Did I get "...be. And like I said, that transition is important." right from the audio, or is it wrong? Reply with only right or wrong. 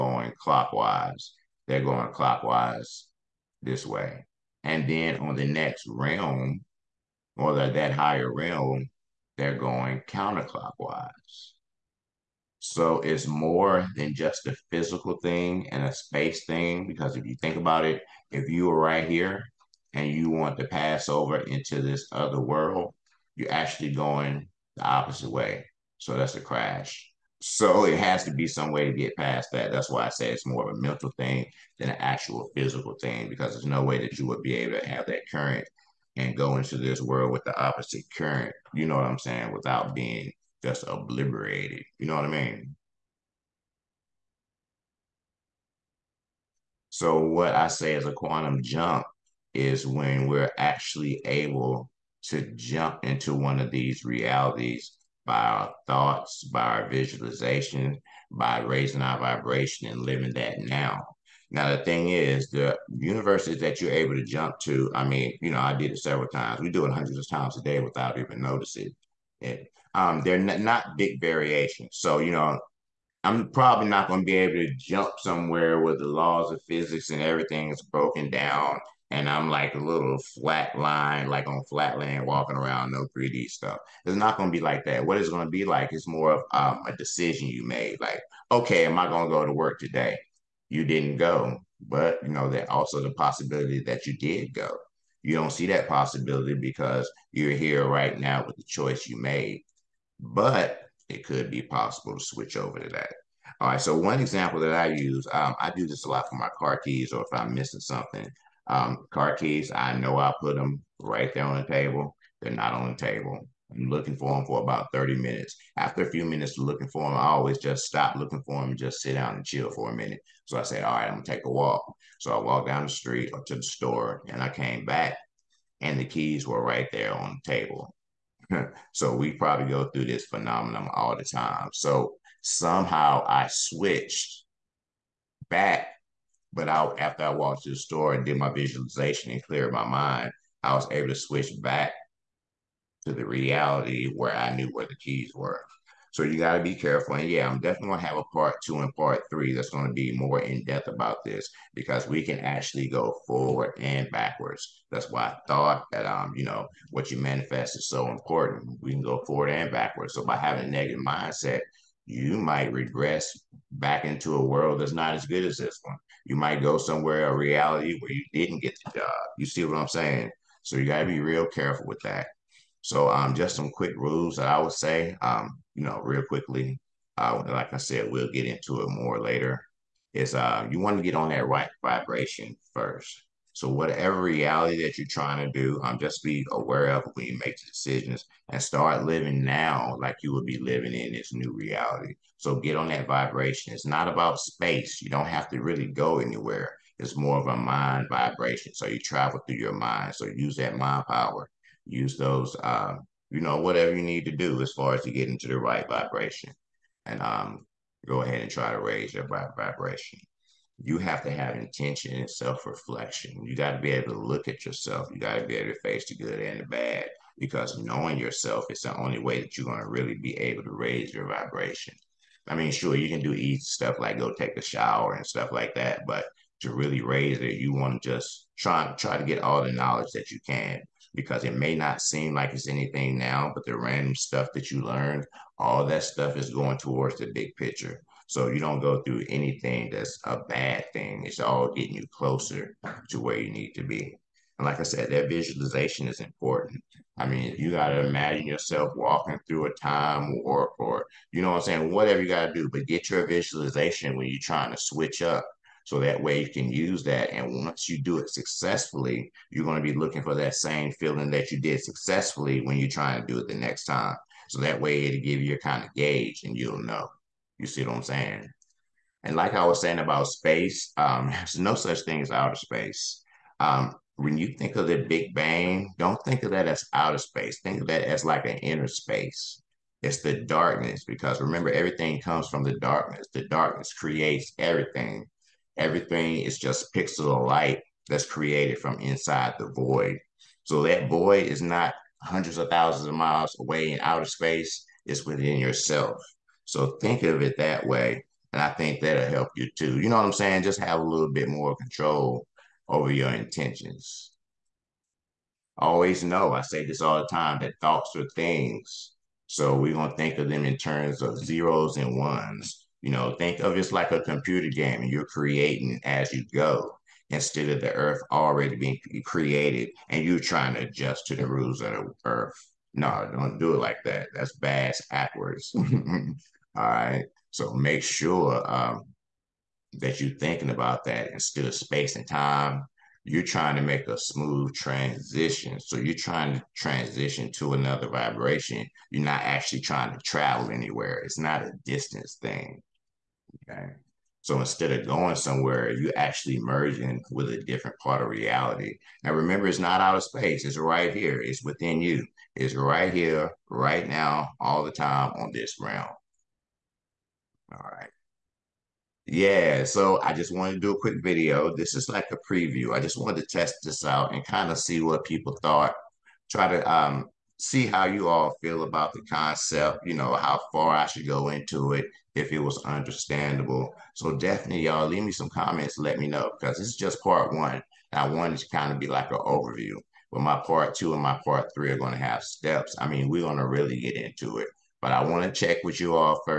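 wrong.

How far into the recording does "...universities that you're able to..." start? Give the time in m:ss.
1:02.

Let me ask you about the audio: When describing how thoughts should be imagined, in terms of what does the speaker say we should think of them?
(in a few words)
Zeros and ones.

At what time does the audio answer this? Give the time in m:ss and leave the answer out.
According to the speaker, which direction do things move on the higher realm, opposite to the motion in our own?
0:10.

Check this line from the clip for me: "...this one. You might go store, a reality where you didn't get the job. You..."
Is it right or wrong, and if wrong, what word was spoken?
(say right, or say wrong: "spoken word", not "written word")
wrong: "somewhere", not "store".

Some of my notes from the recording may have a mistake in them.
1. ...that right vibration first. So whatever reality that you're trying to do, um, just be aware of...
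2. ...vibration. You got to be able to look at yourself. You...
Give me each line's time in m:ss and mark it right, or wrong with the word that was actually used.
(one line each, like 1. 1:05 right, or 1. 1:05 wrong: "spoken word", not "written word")
1. 3:01 right
2. 3:32 wrong: "reflection", not "vibration".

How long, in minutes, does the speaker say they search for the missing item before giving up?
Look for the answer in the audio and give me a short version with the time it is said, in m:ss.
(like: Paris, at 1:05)
30, at 1:54.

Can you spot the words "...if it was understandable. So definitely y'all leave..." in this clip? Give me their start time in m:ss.
6:12.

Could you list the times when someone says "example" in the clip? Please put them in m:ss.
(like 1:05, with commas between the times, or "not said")
1:44.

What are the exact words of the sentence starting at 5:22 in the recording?
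No, don't do it like that.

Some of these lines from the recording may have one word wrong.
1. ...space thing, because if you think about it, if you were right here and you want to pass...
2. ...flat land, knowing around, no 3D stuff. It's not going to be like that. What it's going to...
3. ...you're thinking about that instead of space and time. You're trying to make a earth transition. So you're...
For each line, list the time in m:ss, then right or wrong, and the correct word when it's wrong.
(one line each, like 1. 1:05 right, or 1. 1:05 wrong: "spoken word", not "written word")
1. 0:15 right
2. 1:21 wrong: "walking", not "knowing"
3. 5:30 wrong: "smooth", not "earth".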